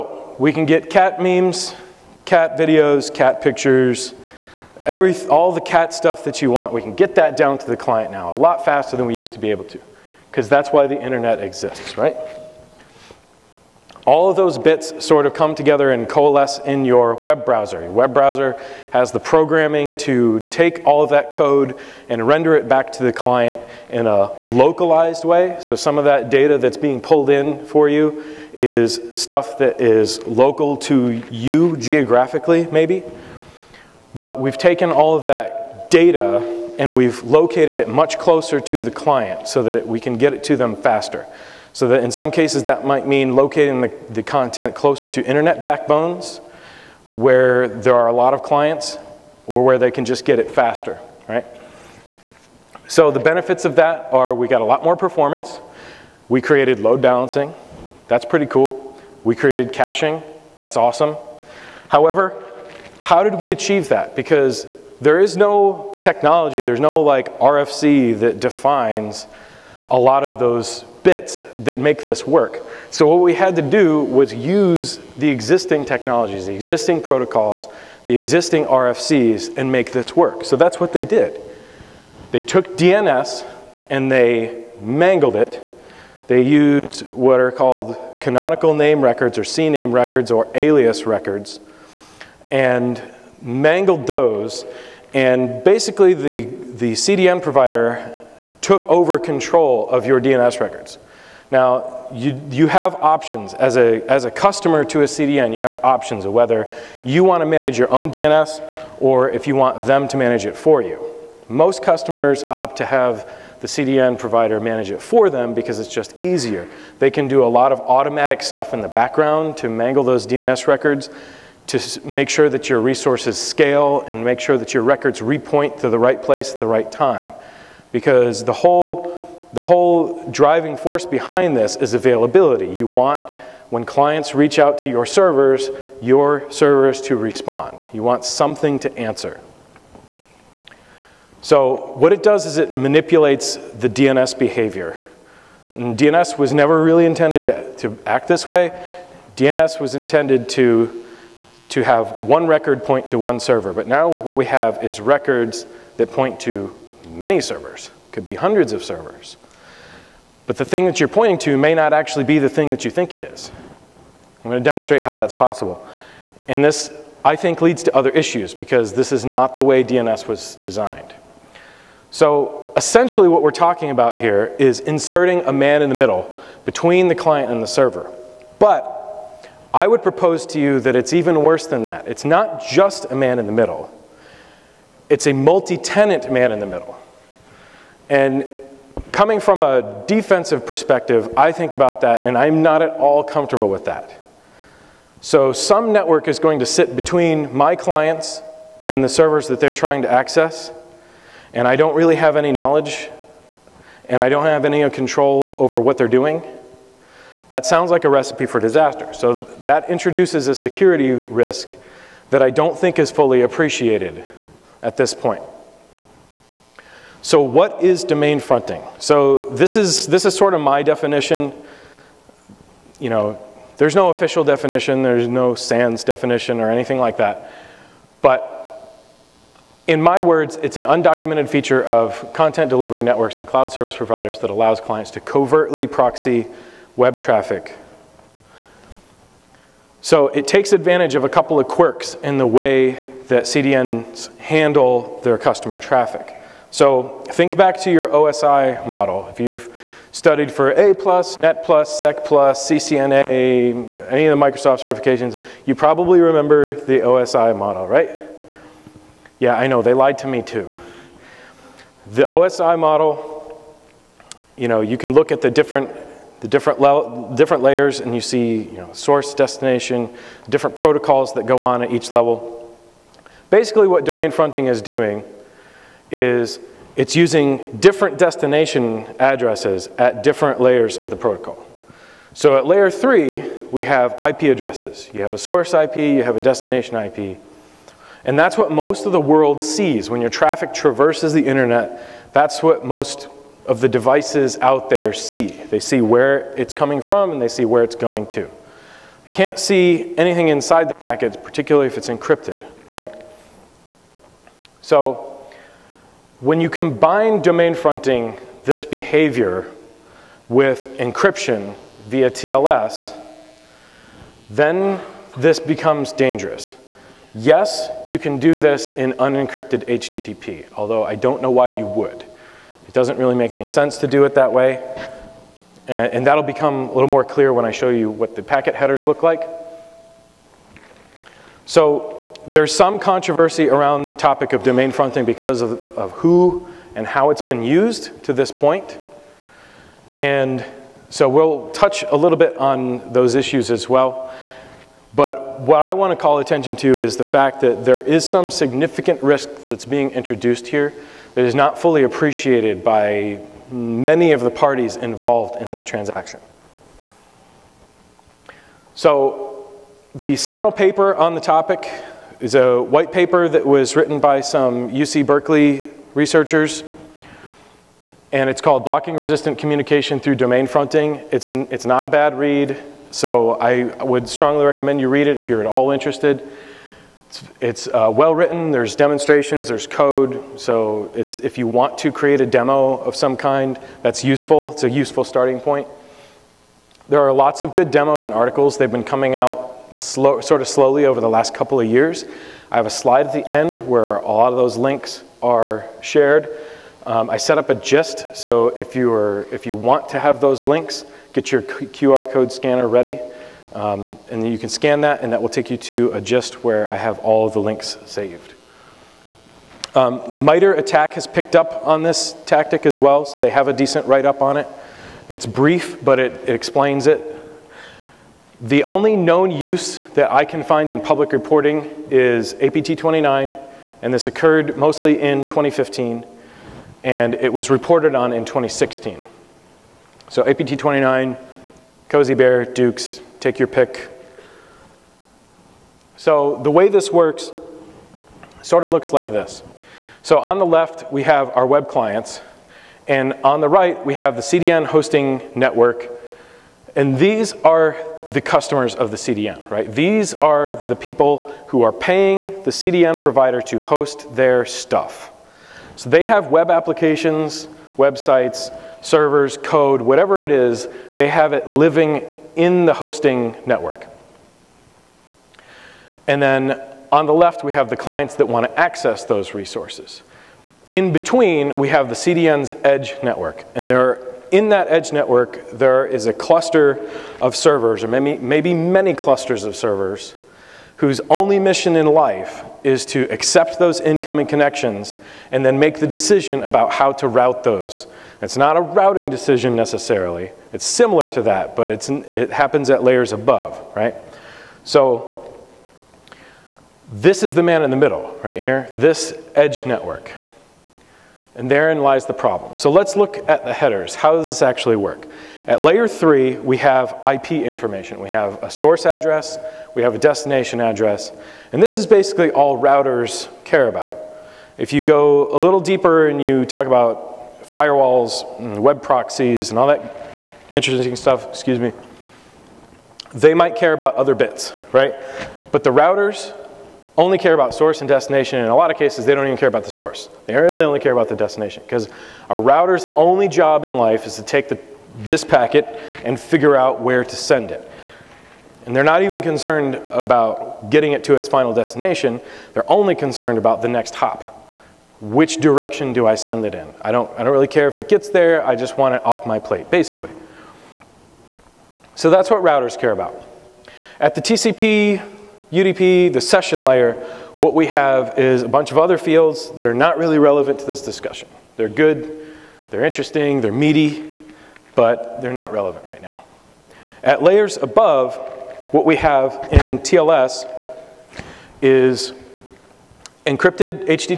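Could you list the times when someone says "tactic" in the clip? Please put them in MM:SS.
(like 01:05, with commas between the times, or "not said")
06:52.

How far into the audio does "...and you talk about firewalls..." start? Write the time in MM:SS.
08:36.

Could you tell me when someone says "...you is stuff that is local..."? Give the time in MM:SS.
00:27.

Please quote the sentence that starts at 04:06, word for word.
So think back to your OSI model.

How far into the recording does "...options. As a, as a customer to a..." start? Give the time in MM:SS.
01:42.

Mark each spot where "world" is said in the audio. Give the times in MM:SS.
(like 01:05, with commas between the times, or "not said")
04:49.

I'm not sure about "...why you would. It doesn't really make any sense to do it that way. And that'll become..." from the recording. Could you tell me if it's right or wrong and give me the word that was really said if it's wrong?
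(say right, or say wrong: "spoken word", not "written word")
right.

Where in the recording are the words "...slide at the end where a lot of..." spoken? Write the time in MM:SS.
06:32.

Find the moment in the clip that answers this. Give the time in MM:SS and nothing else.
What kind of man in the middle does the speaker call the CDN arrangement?
03:05.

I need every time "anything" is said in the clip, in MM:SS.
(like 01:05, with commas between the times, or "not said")
03:46, 05:00.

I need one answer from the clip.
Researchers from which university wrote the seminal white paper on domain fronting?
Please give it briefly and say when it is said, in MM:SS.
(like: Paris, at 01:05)
UC Berkeley, at 06:04.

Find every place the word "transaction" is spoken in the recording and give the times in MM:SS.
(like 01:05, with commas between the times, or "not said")
05:55.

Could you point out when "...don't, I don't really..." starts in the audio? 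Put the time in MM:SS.
09:07.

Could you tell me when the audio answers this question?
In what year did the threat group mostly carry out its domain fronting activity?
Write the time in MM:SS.
07:05.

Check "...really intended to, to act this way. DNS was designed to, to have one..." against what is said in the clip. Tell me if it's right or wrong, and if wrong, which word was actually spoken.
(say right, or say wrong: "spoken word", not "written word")
wrong: "intended", not "designed".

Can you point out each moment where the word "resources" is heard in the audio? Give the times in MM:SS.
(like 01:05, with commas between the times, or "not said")
02:02, 07:49.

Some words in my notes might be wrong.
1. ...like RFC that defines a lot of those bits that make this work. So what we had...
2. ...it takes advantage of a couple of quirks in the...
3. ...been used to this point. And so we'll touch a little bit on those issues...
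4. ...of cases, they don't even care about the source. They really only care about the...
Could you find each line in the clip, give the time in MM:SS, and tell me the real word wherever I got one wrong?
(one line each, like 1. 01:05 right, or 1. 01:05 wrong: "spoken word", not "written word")
1. 01:07 right
2. 04:00 right
3. 05:37 right
4. 08:48 right.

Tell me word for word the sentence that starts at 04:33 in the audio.
Basically, what domain fronting is doing is it's using different destination addresses at different layers of the protocol.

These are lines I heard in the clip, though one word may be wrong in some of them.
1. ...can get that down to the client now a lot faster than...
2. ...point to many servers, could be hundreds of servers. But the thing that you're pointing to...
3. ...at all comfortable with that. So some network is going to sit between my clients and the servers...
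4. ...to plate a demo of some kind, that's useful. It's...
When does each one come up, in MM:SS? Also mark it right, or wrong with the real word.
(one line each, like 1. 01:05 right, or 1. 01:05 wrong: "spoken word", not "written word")
1. 00:06 right
2. 02:36 right
3. 03:12 right
4. 06:21 wrong: "create", not "plate".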